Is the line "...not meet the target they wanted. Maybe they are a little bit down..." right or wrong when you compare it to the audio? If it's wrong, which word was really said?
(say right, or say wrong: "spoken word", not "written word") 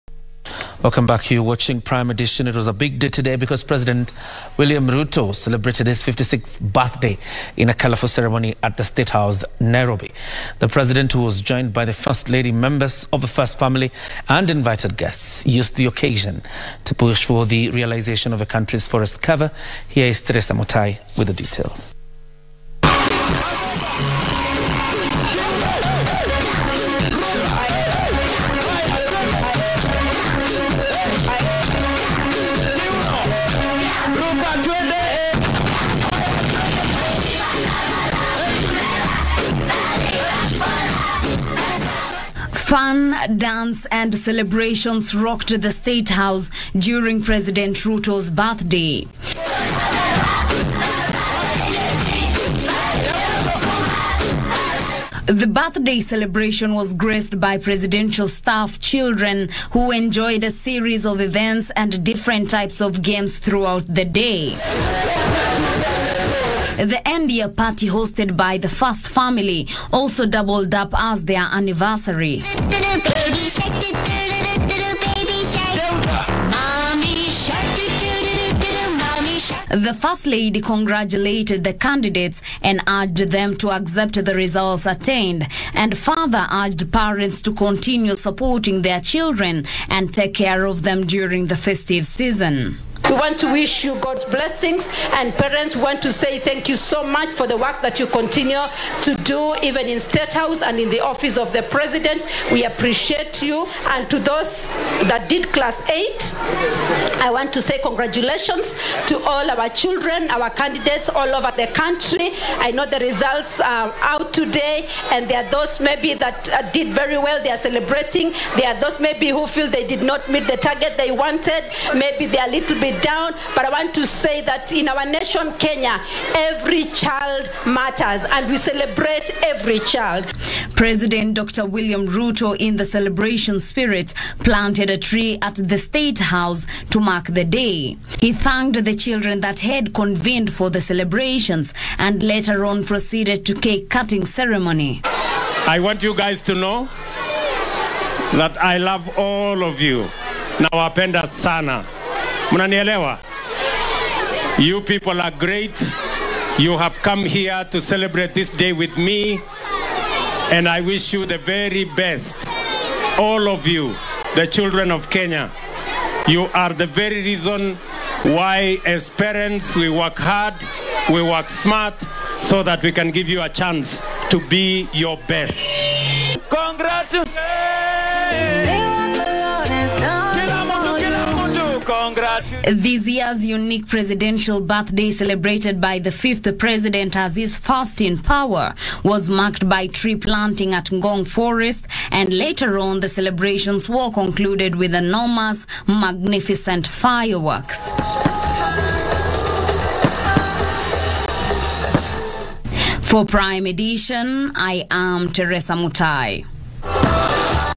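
right.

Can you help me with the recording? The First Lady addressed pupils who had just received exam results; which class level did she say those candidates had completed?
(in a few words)
Class eight.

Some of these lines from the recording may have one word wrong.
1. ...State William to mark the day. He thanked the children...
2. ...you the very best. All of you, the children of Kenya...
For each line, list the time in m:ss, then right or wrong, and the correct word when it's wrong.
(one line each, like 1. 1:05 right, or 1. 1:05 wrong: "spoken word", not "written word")
1. 2:15 wrong: "House", not "William"
2. 2:41 right.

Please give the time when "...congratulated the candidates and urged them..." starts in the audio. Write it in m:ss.
1:20.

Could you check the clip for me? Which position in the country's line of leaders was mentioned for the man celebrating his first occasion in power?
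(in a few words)
Fifth.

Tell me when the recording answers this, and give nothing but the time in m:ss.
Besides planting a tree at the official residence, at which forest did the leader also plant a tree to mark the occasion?
3:10.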